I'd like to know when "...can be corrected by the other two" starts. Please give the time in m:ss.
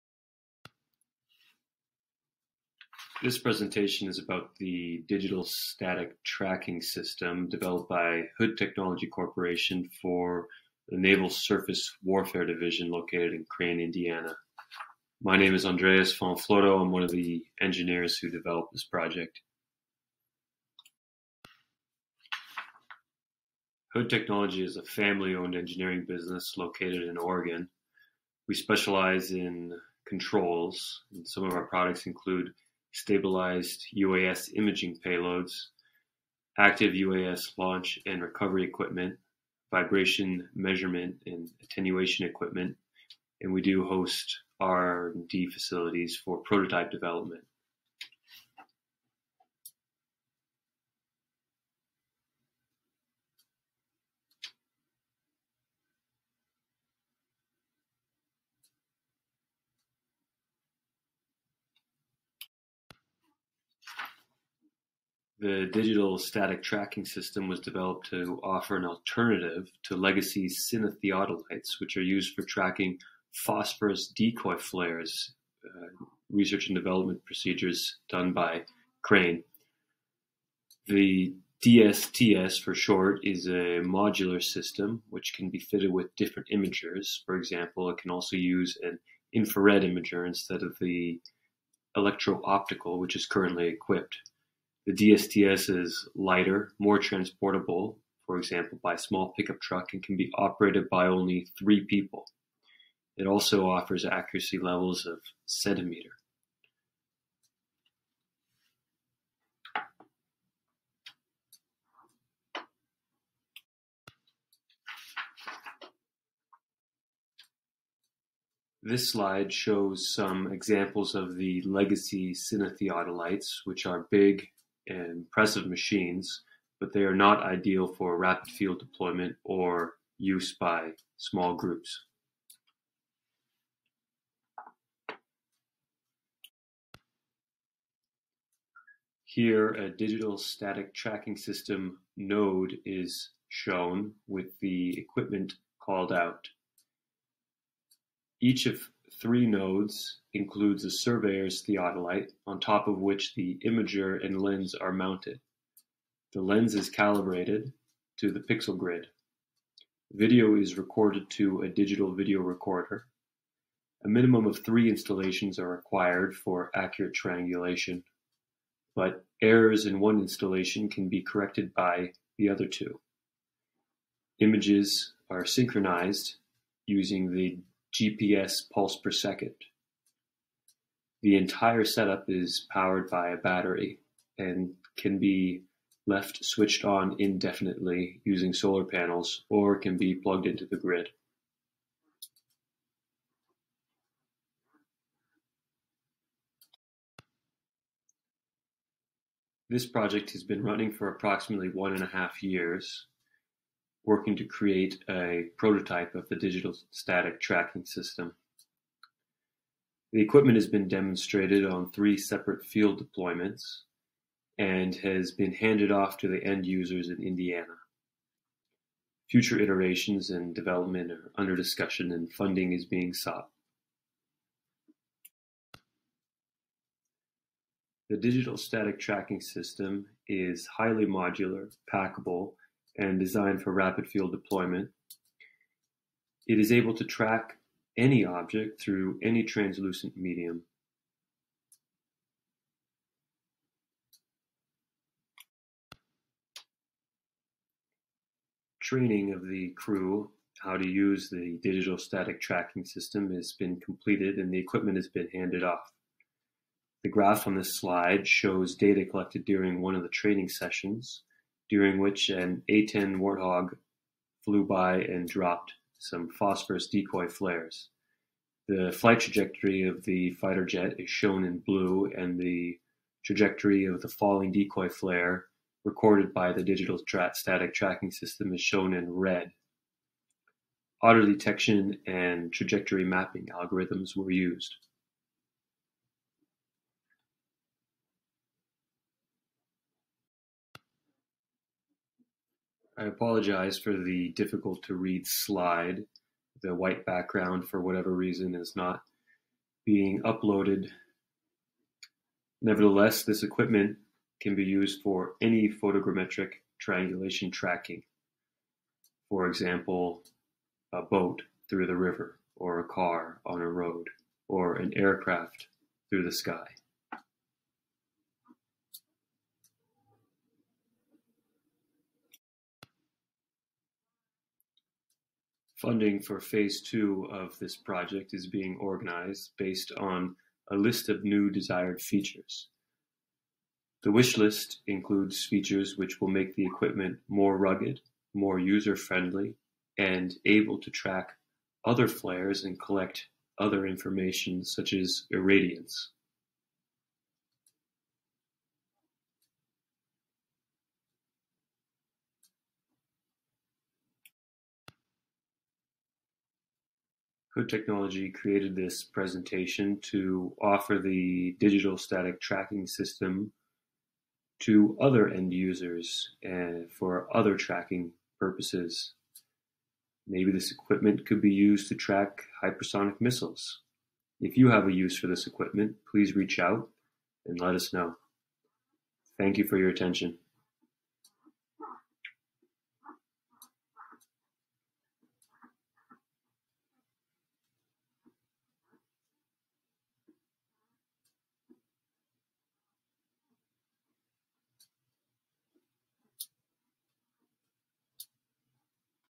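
2:50.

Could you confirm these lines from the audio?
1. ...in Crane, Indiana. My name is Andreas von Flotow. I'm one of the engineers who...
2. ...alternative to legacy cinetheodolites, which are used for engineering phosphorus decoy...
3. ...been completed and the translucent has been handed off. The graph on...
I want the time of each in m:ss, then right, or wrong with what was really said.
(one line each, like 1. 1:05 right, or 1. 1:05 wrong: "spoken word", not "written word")
1. 0:13 right
2. 1:08 wrong: "tracking", not "engineering"
3. 4:13 wrong: "equipment", not "translucent".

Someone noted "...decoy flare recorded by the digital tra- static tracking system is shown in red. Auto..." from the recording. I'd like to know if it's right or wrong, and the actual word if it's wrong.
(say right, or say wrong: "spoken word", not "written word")
right.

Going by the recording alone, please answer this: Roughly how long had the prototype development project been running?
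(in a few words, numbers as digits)
1.5 years.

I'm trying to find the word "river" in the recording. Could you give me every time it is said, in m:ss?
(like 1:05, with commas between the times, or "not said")
5:11.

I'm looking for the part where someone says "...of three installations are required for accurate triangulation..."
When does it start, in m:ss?
2:44.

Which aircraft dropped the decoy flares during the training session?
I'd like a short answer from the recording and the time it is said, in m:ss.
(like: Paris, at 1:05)
A-10 Warthog, at 4:22.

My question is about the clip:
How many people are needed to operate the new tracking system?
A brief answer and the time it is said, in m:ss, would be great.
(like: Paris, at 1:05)
3, at 1:41.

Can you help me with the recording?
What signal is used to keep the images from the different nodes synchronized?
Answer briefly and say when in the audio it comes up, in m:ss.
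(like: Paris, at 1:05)
GPS pulse per second, at 2:57.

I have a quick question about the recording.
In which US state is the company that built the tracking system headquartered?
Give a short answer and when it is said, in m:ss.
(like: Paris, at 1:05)
Oregon, at 0:27.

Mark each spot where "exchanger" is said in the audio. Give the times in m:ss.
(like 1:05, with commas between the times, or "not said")
not said.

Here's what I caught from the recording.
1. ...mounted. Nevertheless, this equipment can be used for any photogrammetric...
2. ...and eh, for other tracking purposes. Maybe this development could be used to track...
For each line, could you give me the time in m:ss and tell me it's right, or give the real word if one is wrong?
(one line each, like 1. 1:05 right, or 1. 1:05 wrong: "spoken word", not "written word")
1. 5:00 wrong: "uploaded", not "mounted"
2. 6:06 wrong: "equipment", not "development".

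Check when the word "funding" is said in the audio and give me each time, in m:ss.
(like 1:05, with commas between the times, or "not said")
3:42, 5:25.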